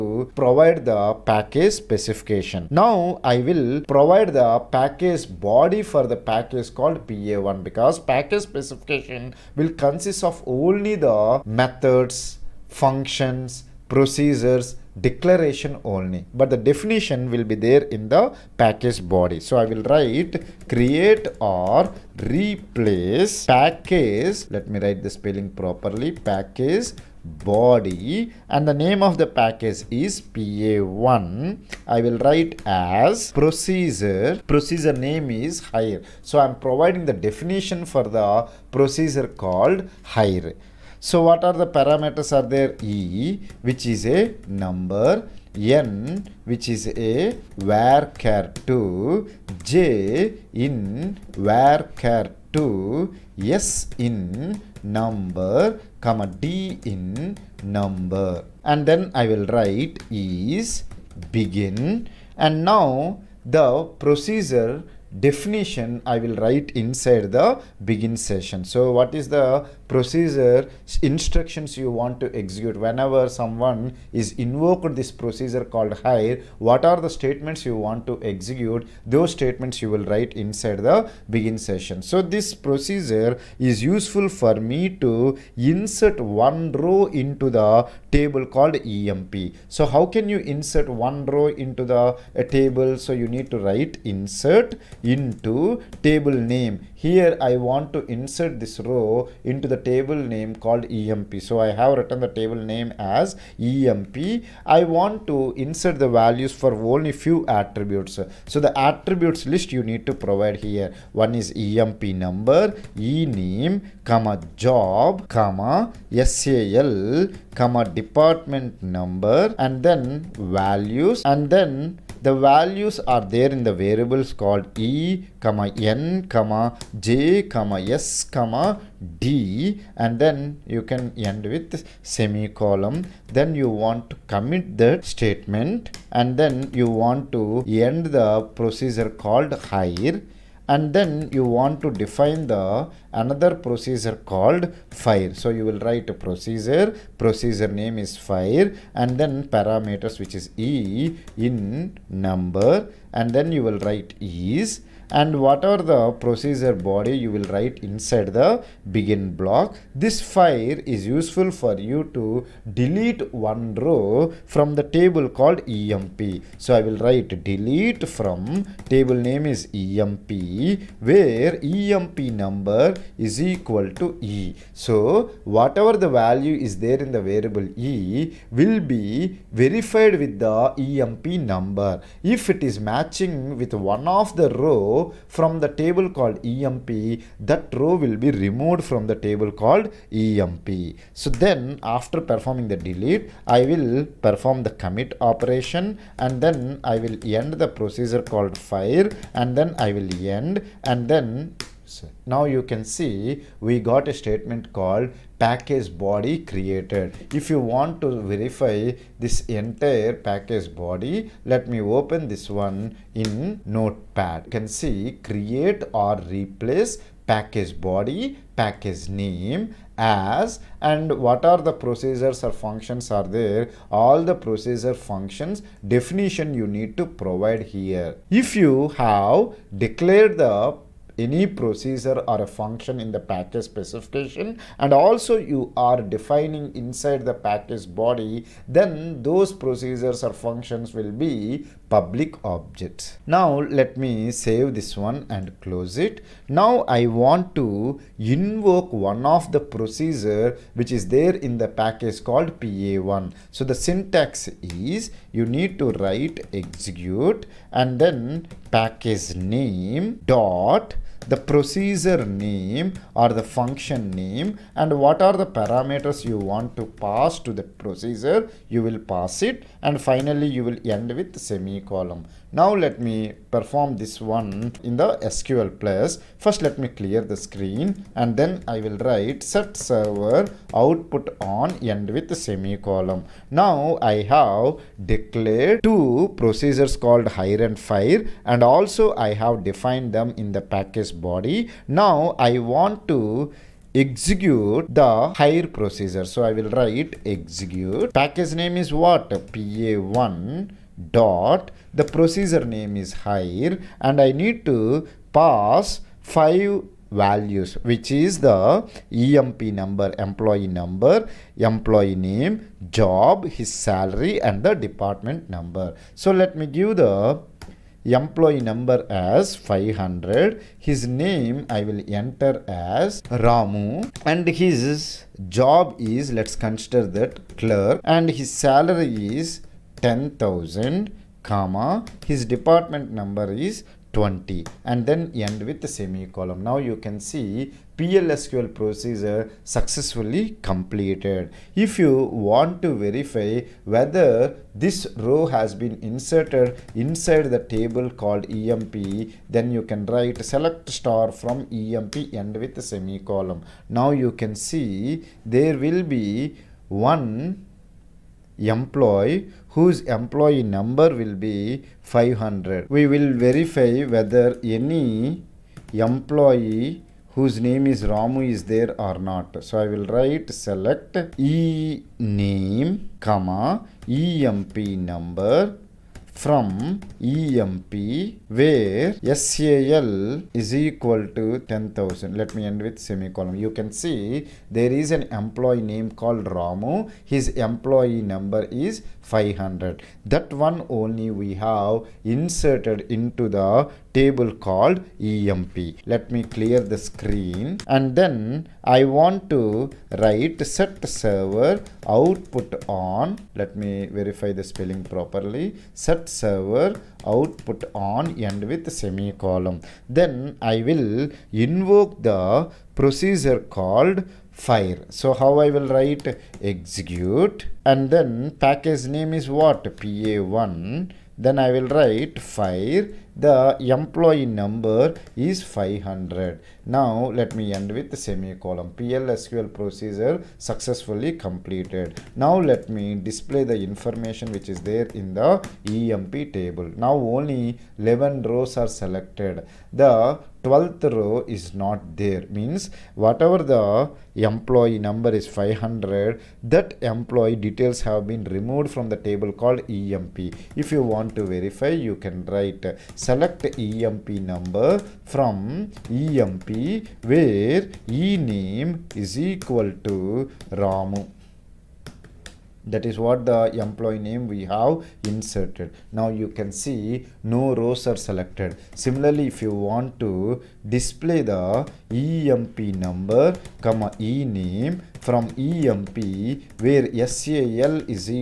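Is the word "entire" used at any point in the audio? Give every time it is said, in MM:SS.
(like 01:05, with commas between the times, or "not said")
03:29.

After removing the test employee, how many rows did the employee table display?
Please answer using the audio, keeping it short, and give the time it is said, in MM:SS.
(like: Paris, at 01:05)
11, at 07:17.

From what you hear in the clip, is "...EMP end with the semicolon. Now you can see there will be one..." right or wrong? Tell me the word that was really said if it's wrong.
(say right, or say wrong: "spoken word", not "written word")
right.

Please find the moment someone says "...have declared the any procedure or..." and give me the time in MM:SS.
03:48.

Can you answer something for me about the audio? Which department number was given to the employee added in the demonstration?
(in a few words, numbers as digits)
20.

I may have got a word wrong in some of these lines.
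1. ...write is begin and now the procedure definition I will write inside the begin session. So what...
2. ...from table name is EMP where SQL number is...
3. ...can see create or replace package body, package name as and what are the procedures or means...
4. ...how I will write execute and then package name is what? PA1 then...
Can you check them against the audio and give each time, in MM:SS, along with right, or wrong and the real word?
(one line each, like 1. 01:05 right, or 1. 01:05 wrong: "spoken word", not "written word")
1. 00:59 right
2. 02:48 wrong: "EMP", not "SQL"
3. 03:34 wrong: "functions", not "means"
4. 06:55 right.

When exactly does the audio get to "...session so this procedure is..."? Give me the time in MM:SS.
01:21.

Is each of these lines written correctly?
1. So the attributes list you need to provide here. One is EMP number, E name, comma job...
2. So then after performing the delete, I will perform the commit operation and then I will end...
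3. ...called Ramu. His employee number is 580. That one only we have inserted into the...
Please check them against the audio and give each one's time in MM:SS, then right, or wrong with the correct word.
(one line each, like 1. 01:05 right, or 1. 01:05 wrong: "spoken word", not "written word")
1. 01:48 right
2. 03:11 right
3. 06:26 wrong: "500", not "580".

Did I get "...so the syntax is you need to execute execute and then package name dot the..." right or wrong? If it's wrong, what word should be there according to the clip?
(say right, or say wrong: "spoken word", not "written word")
wrong: "write", not "execute".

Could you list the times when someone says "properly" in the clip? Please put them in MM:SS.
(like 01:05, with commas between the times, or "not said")
00:25, 06:45.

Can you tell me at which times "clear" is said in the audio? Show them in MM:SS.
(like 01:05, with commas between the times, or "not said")
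04:36, 06:36.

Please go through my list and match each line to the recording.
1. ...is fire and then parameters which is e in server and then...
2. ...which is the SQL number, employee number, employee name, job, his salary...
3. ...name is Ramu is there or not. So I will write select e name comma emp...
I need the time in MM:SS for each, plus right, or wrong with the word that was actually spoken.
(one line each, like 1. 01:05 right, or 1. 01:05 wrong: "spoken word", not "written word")
1. 02:28 wrong: "number", not "server"
2. 05:07 wrong: "EMP", not "SQL"
3. 06:07 right.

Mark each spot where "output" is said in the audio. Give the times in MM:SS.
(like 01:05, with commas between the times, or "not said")
04:40, 06:42, 06:47.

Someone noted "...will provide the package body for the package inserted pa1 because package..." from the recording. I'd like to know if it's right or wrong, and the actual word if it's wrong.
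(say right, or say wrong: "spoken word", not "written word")
wrong: "called", not "inserted".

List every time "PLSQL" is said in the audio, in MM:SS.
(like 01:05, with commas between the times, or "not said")
05:37, 07:08.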